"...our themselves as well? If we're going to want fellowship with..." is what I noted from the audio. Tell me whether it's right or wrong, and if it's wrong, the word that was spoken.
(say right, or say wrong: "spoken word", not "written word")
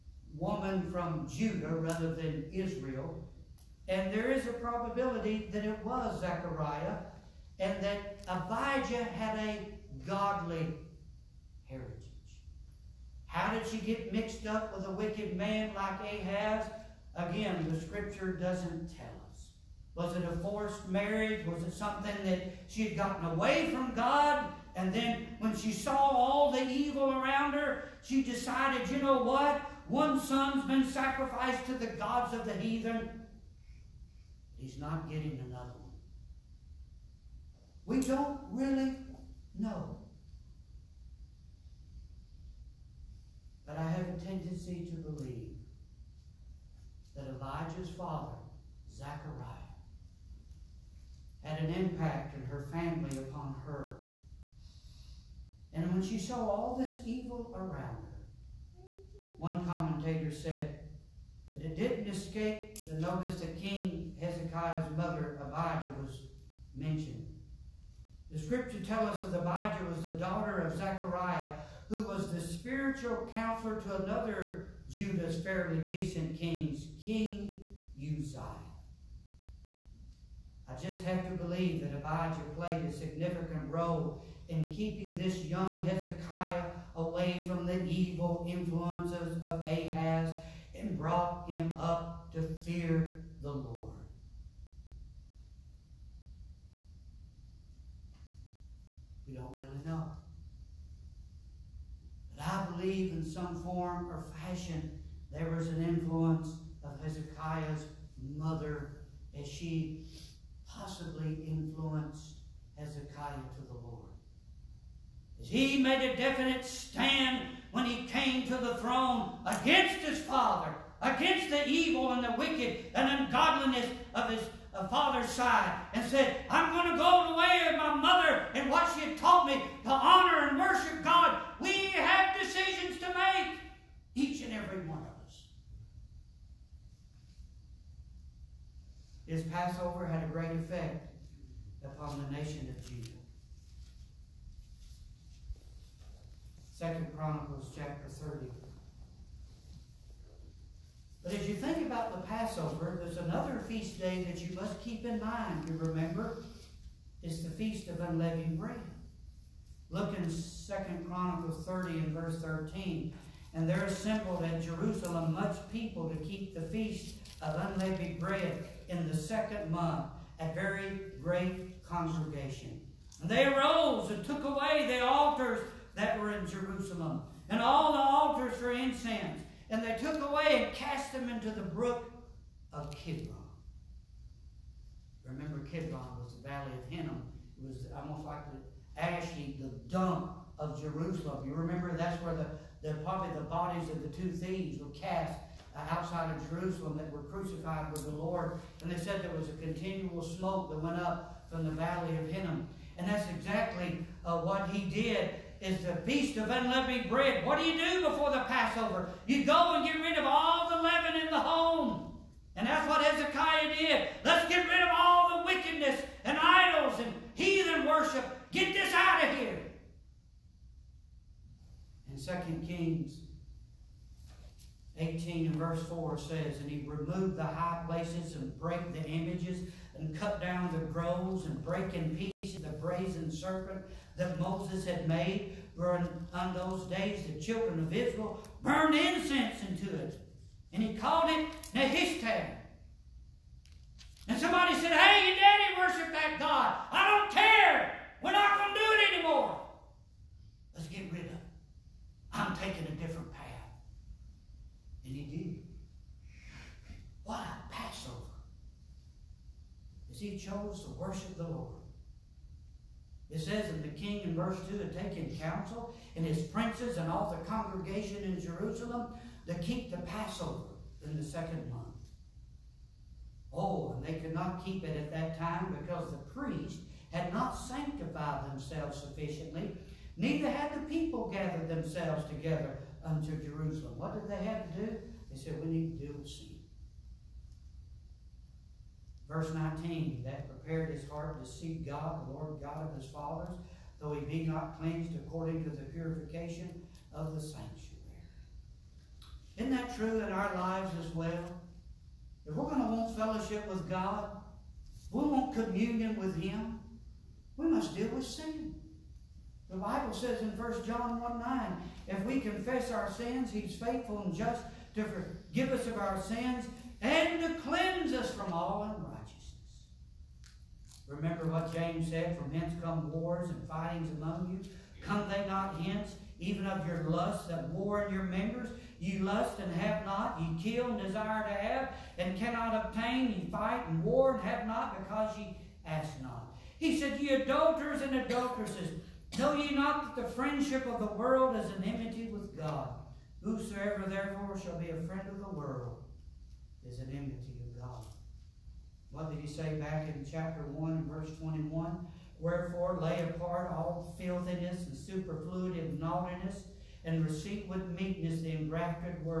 wrong: "lives", not "themselves".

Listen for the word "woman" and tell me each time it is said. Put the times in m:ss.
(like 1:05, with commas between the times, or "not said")
0:00.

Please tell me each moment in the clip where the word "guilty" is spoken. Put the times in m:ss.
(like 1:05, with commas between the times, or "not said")
not said.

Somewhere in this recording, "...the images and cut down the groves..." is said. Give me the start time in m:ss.
3:48.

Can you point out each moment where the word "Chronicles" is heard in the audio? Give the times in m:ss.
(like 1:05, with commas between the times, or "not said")
2:27, 2:41.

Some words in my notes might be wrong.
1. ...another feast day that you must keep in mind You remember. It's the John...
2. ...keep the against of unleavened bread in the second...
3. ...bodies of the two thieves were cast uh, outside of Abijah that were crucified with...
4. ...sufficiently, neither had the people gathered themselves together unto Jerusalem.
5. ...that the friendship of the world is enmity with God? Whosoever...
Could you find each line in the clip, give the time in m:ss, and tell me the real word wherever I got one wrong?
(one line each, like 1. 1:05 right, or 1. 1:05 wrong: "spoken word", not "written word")
1. 2:33 wrong: "Feast", not "John"
2. 2:46 wrong: "feast", not "against"
3. 3:13 wrong: "Jerusalem", not "Abijah"
4. 4:39 right
5. 5:40 right.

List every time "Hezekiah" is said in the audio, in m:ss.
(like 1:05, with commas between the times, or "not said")
1:04, 1:25, 1:47, 1:52, 3:33.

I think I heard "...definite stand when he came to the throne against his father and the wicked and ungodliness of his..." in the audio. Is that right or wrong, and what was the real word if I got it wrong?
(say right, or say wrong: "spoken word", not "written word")
right.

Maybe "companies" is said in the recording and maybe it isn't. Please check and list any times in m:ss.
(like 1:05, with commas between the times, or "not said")
not said.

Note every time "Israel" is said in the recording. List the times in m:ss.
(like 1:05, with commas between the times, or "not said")
0:02, 3:57.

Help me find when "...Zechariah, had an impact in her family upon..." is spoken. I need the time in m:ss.
0:48.